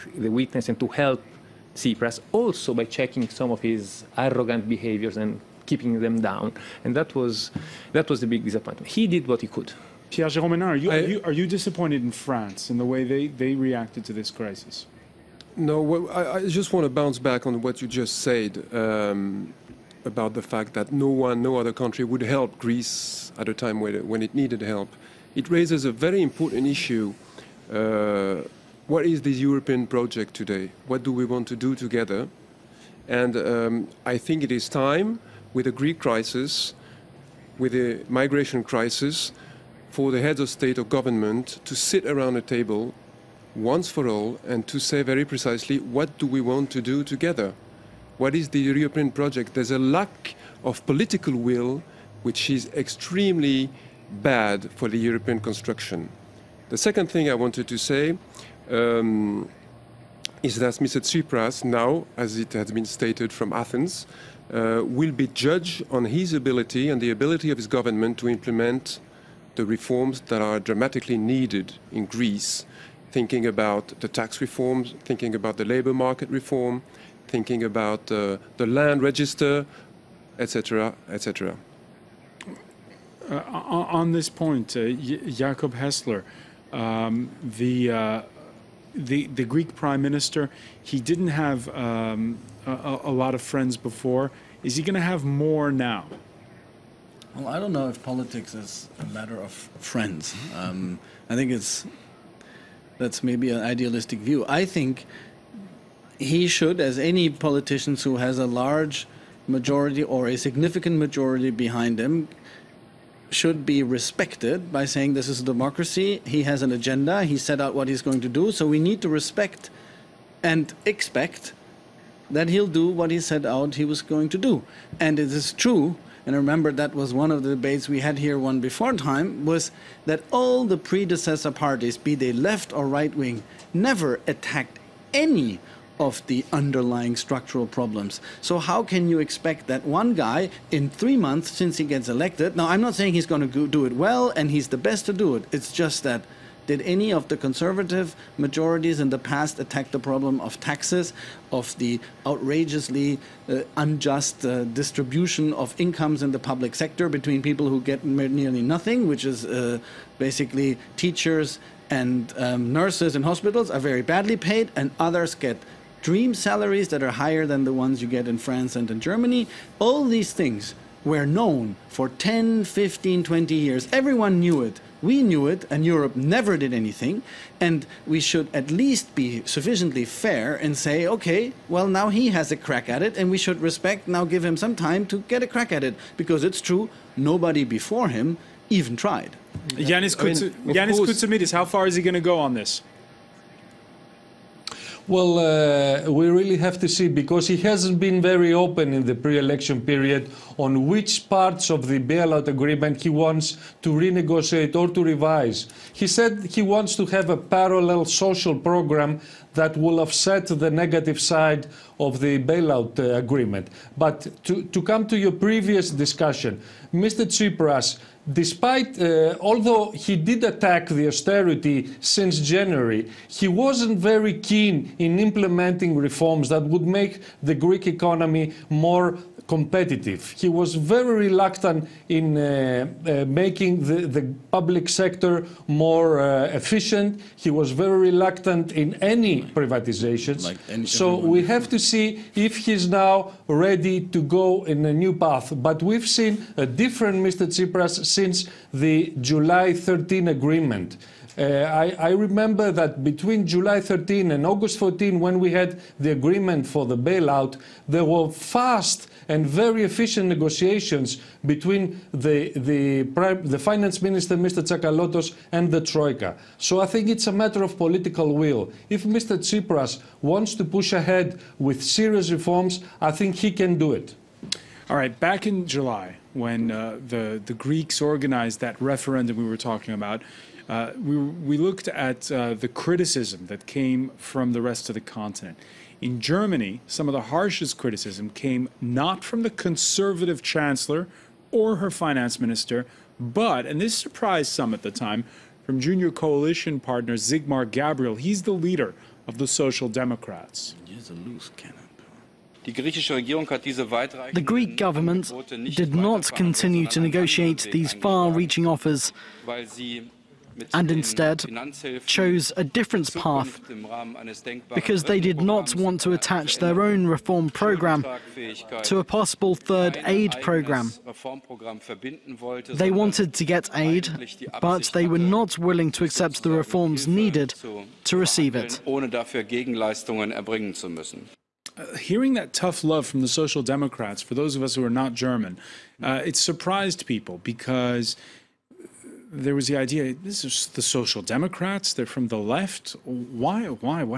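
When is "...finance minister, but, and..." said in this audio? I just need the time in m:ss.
4:51.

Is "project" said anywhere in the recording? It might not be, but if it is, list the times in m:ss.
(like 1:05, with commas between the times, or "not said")
0:29, 0:49.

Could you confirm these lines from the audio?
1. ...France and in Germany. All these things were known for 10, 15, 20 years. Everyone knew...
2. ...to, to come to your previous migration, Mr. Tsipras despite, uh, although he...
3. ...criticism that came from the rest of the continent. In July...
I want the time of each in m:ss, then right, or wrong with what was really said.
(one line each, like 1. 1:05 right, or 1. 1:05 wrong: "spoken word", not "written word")
1. 2:48 right
2. 3:34 wrong: "discussion", not "migration"
3. 4:42 wrong: "Germany", not "July".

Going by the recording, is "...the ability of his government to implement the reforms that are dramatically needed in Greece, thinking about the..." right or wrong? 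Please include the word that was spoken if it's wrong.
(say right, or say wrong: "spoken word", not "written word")
right.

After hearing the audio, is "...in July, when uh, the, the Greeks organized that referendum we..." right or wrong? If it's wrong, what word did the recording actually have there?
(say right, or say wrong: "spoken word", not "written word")
right.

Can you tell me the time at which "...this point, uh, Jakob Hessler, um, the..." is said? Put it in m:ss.
1:24.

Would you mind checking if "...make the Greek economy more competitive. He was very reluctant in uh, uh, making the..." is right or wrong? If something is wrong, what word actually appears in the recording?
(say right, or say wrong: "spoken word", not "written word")
right.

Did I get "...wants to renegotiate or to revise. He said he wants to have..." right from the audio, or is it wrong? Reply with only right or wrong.
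right.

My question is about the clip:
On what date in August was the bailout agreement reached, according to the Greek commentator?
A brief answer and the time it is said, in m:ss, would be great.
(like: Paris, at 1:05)
August 14, at 4:14.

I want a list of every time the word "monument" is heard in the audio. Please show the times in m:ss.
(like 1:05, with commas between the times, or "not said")
not said.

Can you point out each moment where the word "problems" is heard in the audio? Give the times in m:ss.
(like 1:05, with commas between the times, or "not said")
2:17, 2:29.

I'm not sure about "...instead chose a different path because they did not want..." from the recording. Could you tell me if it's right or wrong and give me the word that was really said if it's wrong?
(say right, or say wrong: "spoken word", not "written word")
right.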